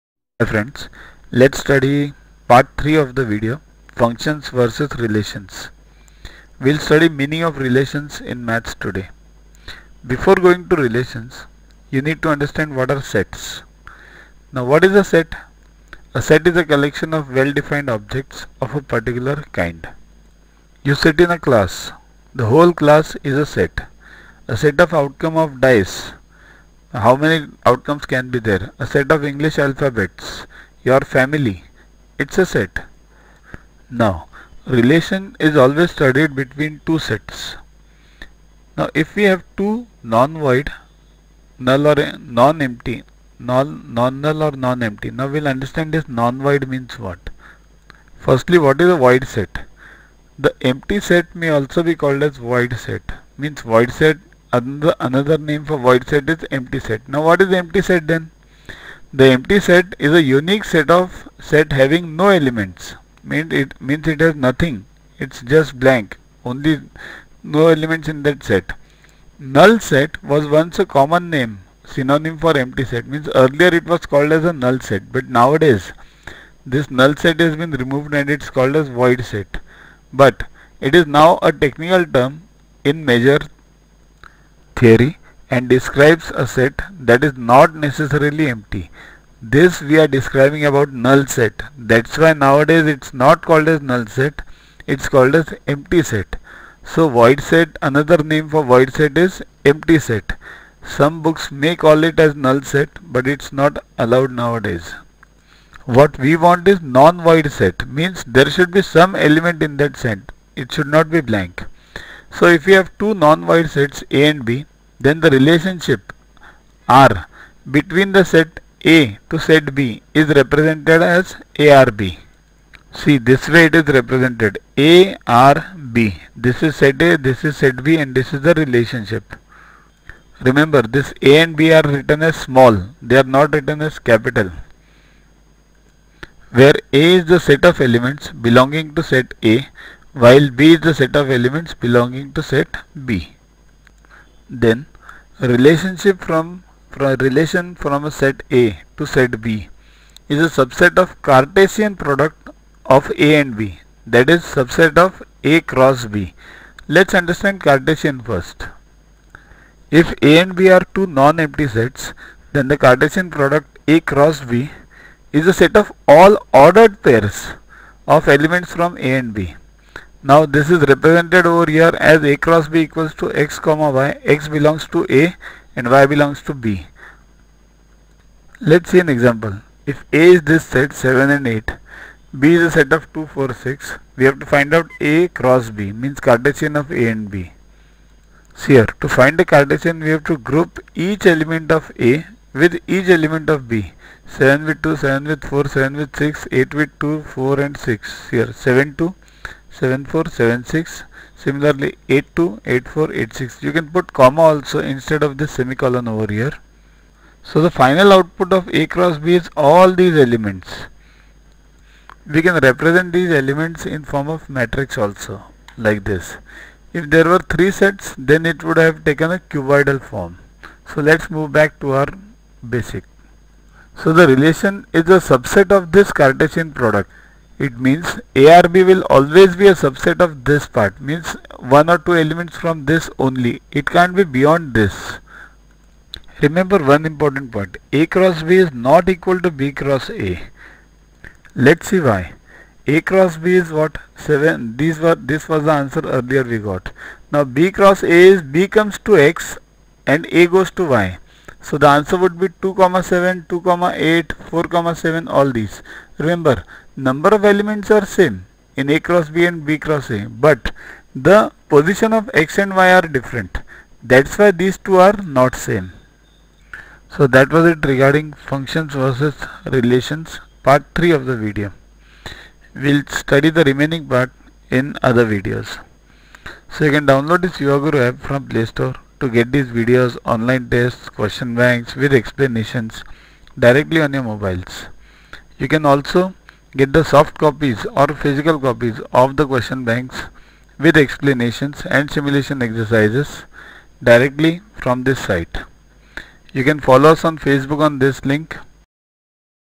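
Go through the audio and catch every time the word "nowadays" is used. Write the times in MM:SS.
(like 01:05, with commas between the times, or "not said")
01:15, 01:32, 01:44.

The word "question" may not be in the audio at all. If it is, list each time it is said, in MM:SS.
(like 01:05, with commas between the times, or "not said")
04:41, 04:49.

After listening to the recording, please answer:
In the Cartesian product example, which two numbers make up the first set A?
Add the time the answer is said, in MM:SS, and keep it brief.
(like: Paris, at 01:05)
7 and 8, at 03:00.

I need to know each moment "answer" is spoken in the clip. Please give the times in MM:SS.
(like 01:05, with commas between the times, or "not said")
04:05, 04:11.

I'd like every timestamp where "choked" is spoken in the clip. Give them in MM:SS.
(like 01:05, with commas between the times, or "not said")
not said.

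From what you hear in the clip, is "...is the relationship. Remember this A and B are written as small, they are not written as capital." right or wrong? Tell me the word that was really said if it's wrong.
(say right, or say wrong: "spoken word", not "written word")
right.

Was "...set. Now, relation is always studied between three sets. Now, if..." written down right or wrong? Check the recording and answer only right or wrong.
wrong.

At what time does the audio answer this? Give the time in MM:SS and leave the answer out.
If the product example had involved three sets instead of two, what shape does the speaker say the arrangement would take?
03:39.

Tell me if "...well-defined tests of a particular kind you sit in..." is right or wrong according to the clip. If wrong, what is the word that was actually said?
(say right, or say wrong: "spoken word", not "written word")
wrong: "objects", not "tests".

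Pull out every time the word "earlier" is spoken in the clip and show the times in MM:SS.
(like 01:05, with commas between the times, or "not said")
01:13, 04:06.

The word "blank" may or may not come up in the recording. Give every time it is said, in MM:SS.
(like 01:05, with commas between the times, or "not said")
01:05, 01:51.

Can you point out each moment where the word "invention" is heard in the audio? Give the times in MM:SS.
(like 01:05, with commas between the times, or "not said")
not said.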